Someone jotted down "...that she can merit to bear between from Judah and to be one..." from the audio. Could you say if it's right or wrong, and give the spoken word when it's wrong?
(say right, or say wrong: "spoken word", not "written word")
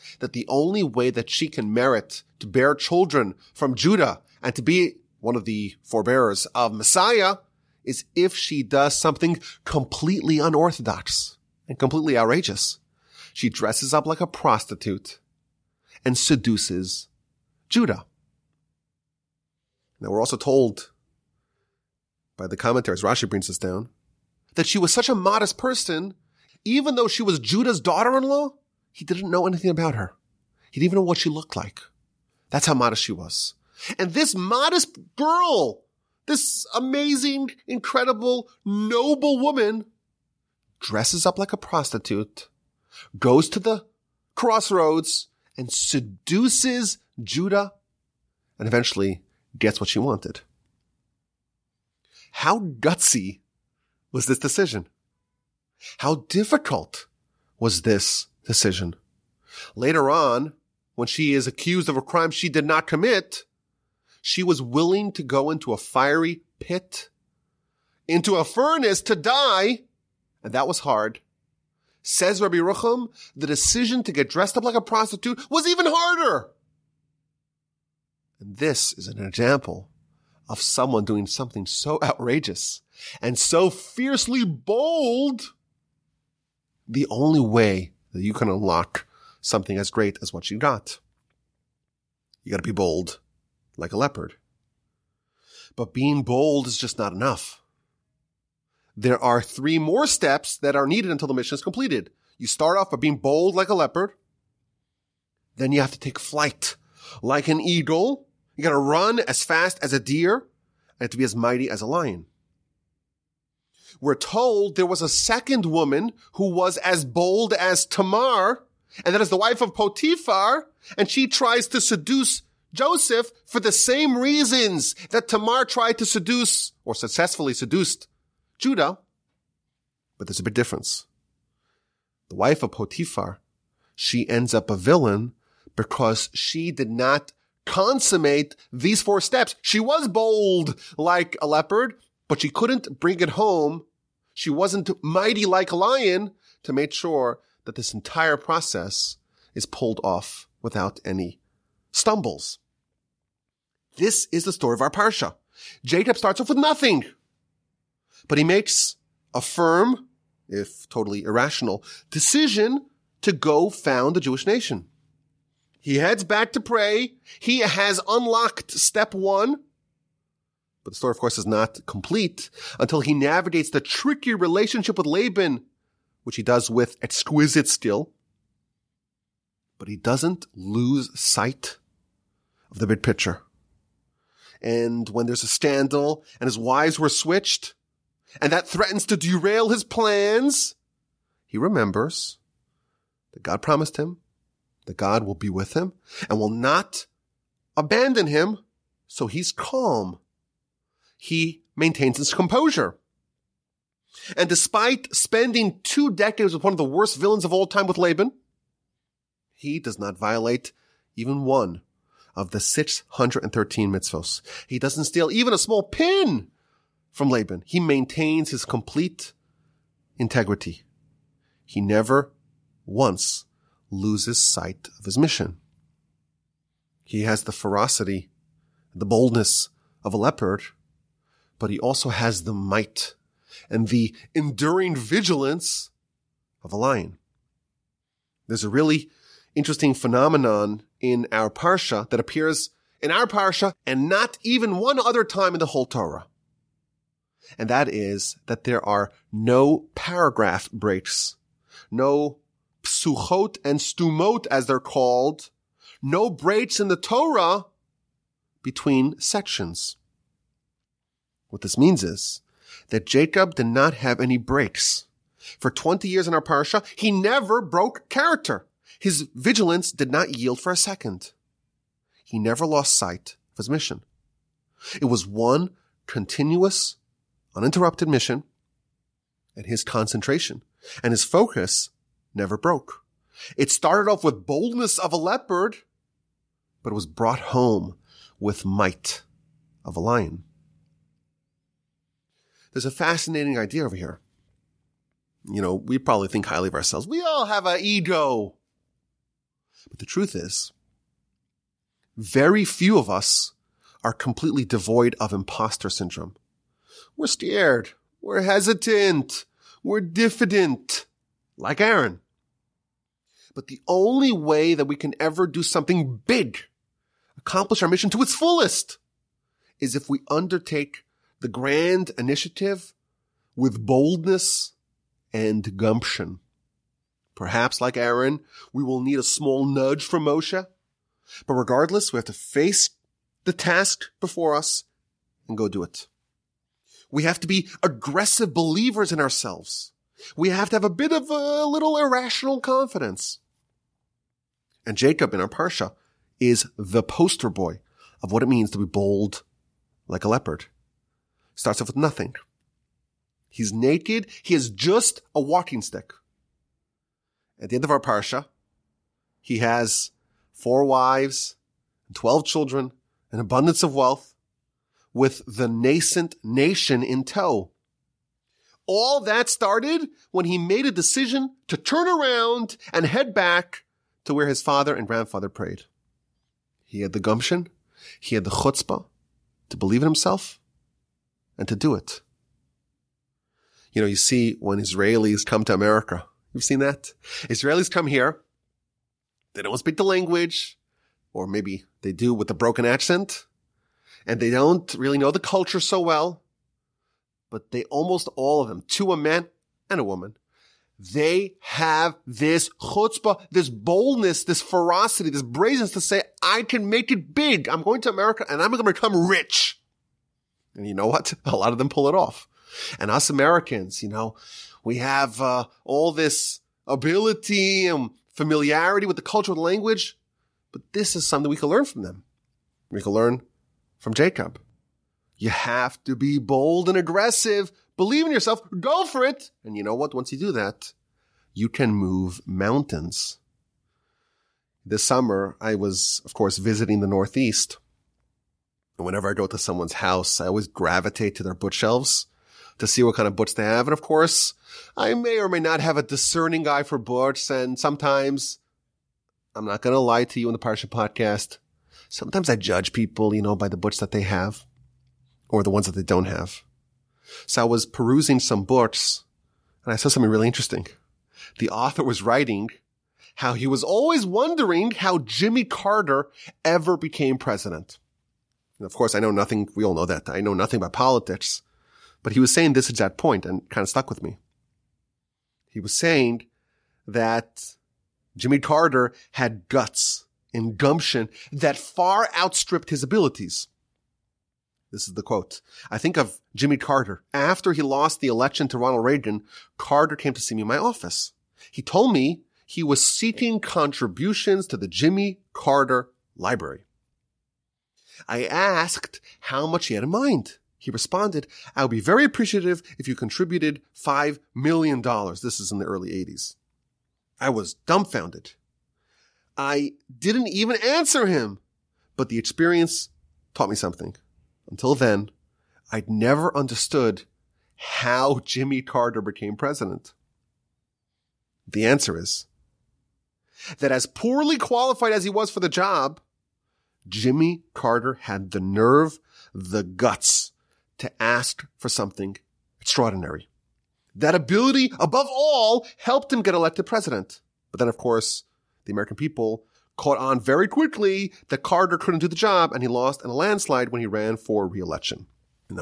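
wrong: "children", not "between".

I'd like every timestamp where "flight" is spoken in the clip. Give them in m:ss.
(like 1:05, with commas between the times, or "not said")
1:46.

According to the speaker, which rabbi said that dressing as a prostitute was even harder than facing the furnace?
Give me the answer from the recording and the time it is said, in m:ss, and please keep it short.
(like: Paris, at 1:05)
Rabbi Yerucham, at 1:12.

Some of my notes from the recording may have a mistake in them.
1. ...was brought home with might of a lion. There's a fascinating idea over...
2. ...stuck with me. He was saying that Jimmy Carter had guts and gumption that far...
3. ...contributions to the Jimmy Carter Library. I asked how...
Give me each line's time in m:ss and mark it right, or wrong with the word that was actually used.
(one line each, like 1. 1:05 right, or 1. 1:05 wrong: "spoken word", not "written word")
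1. 4:46 right
2. 7:53 right
3. 8:13 right.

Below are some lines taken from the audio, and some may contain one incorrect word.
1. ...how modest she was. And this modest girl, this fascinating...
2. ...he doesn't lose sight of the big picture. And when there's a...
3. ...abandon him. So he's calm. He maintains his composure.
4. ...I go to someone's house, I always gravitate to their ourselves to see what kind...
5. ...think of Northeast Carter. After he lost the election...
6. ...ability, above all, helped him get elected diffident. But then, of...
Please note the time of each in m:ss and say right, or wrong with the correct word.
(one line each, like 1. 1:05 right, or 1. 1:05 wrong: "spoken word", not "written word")
1. 0:32 wrong: "amazing", not "fascinating"
2. 2:59 right
3. 3:17 right
4. 7:19 wrong: "bookshelves", not "ourselves"
5. 8:05 wrong: "Jimmy", not "Northeast"
6. 8:54 wrong: "president", not "diffident".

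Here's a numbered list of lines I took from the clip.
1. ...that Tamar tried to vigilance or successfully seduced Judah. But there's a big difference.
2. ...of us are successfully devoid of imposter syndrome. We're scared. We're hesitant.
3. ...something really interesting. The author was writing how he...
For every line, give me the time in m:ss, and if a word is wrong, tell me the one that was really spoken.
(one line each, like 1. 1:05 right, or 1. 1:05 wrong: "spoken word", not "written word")
1. 2:05 wrong: "seduce", not "vigilance"
2. 5:02 wrong: "completely", not "successfully"
3. 7:40 right.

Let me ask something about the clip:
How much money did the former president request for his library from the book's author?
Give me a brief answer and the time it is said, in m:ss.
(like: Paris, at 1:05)
$5 million, at 8:24.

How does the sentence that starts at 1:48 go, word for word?
You gotta run as fast as a deer and to be as mighty as a lion.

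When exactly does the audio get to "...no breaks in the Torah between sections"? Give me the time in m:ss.
4:16.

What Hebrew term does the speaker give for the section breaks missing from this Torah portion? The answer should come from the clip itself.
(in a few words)
Psuchot and stumot.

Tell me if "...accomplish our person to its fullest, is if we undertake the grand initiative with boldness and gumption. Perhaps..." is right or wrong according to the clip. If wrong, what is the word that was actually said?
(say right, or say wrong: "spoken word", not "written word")
wrong: "mission", not "person".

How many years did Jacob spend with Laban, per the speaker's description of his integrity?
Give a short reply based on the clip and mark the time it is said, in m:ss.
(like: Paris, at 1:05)
2 decades, at 3:25.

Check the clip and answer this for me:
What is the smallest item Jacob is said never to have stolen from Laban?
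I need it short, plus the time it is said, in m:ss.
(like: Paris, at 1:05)
A small pin, at 3:35.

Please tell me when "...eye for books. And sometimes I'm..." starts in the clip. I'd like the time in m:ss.
7:26.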